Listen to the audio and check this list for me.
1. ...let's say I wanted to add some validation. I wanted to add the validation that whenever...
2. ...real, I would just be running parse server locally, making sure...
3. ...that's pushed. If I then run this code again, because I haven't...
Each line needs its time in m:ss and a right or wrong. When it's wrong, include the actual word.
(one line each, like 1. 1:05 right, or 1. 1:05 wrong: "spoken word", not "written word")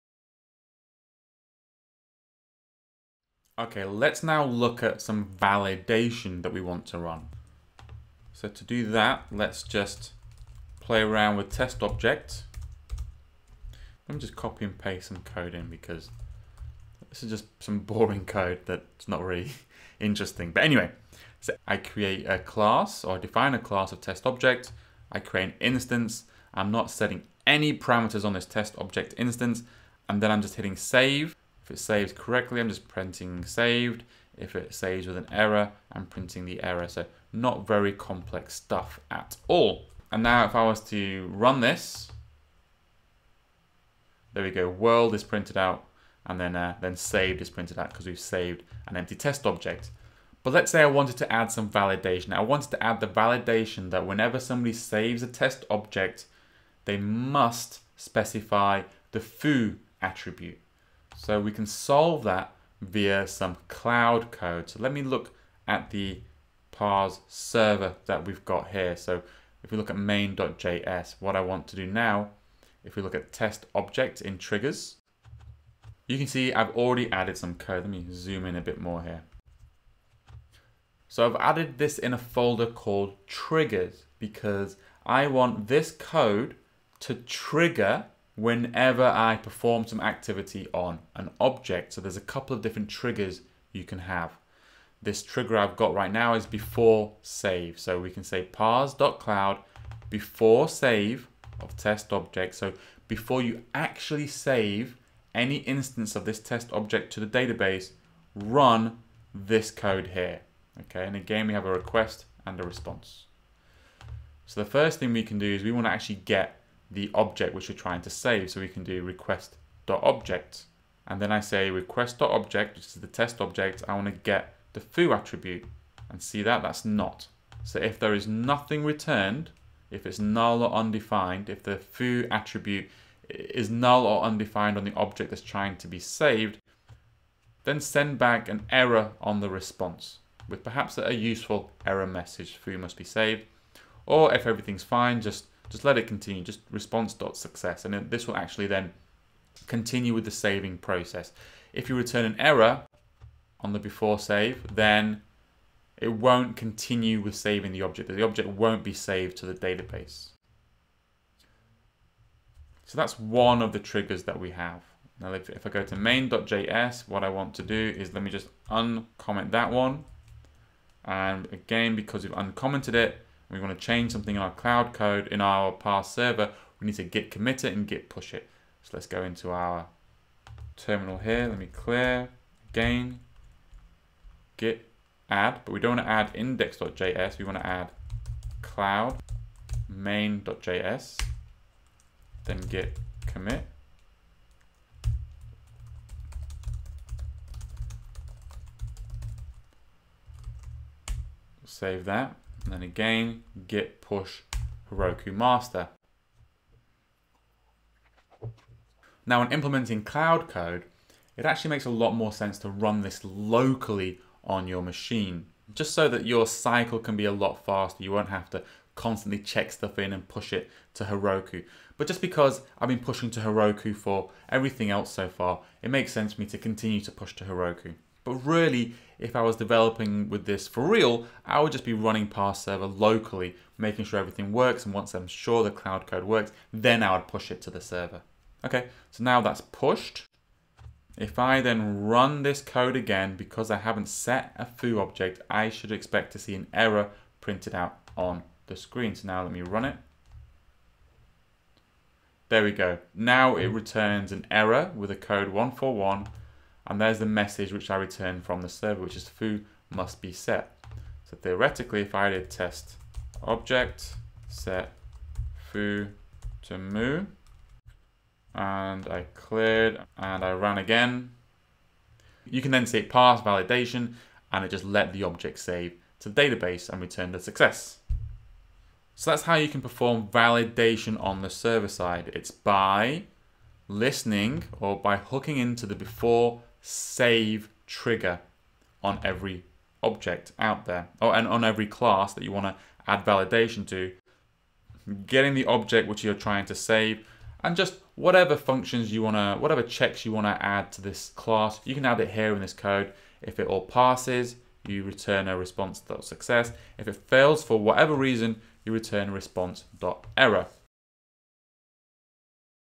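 1. 0:50 right
2. 3:50 right
3. 3:59 right.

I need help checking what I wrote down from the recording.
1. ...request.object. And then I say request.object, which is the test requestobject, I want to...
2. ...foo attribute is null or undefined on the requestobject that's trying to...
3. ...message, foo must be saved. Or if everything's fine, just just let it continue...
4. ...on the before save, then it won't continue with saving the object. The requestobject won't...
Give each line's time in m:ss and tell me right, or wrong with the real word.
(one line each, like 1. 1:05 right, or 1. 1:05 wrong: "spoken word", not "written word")
1. 1:59 wrong: "object", not "requestobject"
2. 2:11 wrong: "object", not "requestobject"
3. 2:22 right
4. 2:33 wrong: "object", not "requestobject".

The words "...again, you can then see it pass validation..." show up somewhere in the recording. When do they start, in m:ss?
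4:30.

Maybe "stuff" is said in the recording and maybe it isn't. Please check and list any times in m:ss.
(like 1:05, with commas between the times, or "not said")
0:38, 3:39.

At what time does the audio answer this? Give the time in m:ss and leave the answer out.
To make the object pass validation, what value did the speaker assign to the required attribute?
4:26.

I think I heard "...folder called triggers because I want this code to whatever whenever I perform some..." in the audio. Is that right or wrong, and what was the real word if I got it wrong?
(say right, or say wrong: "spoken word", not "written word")
wrong: "trigger", not "whatever".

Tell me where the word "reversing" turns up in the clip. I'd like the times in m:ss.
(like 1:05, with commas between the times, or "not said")
not said.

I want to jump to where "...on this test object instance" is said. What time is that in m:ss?
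0:28.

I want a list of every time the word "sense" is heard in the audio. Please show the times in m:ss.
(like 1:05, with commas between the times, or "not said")
3:32, 3:46.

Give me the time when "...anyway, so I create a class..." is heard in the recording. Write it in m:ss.
0:20.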